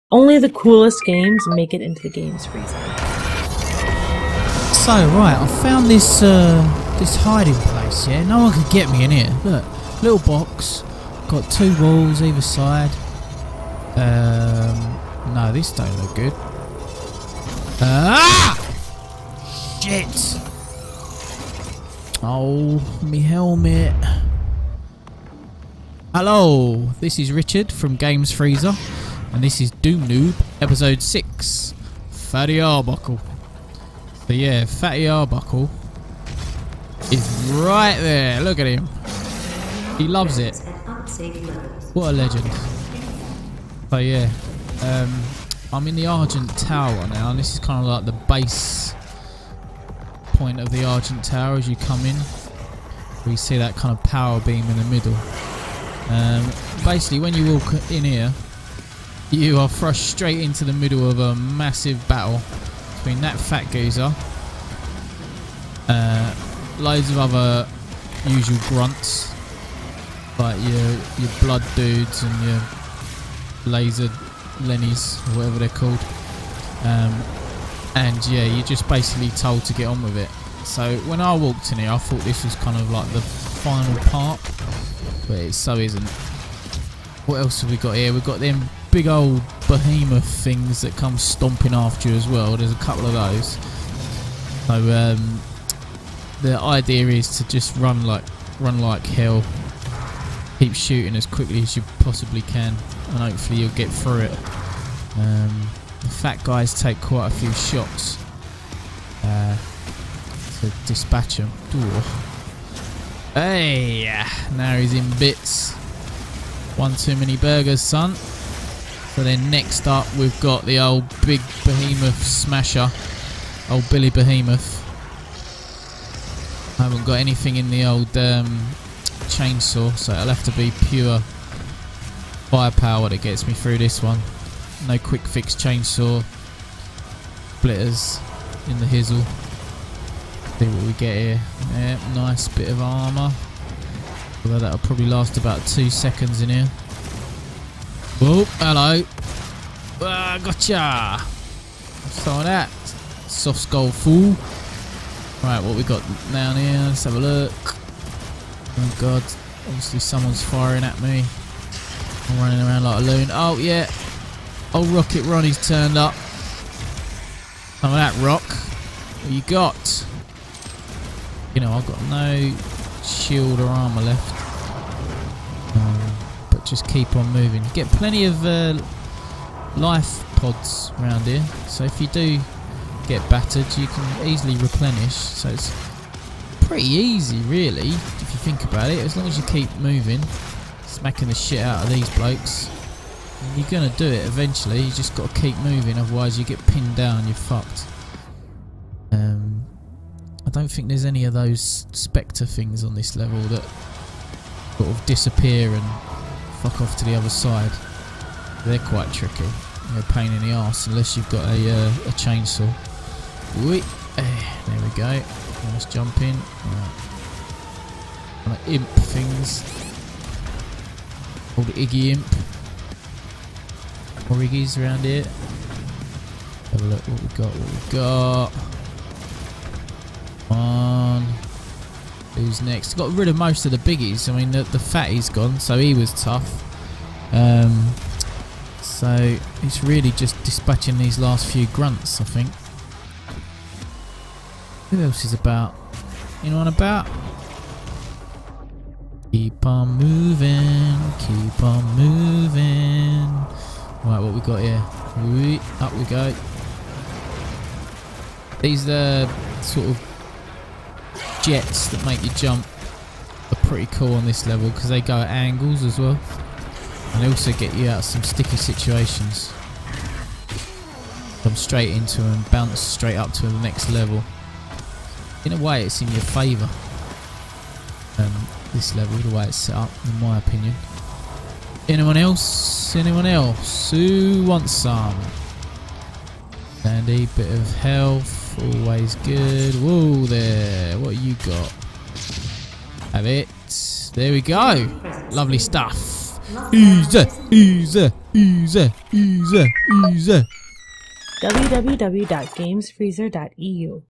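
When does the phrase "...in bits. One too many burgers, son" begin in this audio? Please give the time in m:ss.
1:54.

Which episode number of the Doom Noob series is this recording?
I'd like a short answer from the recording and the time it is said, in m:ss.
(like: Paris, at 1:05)
6, at 0:30.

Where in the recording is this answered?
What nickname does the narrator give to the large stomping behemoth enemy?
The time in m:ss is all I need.
2:03.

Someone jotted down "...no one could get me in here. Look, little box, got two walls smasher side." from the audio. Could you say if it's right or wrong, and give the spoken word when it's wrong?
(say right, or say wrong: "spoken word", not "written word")
wrong: "either", not "smasher".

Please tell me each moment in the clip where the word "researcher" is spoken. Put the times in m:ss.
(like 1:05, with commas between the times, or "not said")
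not said.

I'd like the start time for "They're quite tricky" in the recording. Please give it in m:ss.
3:28.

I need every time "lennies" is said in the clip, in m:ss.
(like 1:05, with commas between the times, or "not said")
1:14.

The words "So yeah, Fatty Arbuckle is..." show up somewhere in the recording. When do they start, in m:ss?
0:34.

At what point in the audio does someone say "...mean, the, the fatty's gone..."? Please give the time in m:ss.
3:54.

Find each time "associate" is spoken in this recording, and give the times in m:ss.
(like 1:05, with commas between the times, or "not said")
not said.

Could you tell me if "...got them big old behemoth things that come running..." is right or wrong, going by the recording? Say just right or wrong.
wrong.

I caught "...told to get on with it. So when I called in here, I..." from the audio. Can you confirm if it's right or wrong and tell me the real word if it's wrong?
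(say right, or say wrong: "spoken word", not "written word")
wrong: "walked", not "called".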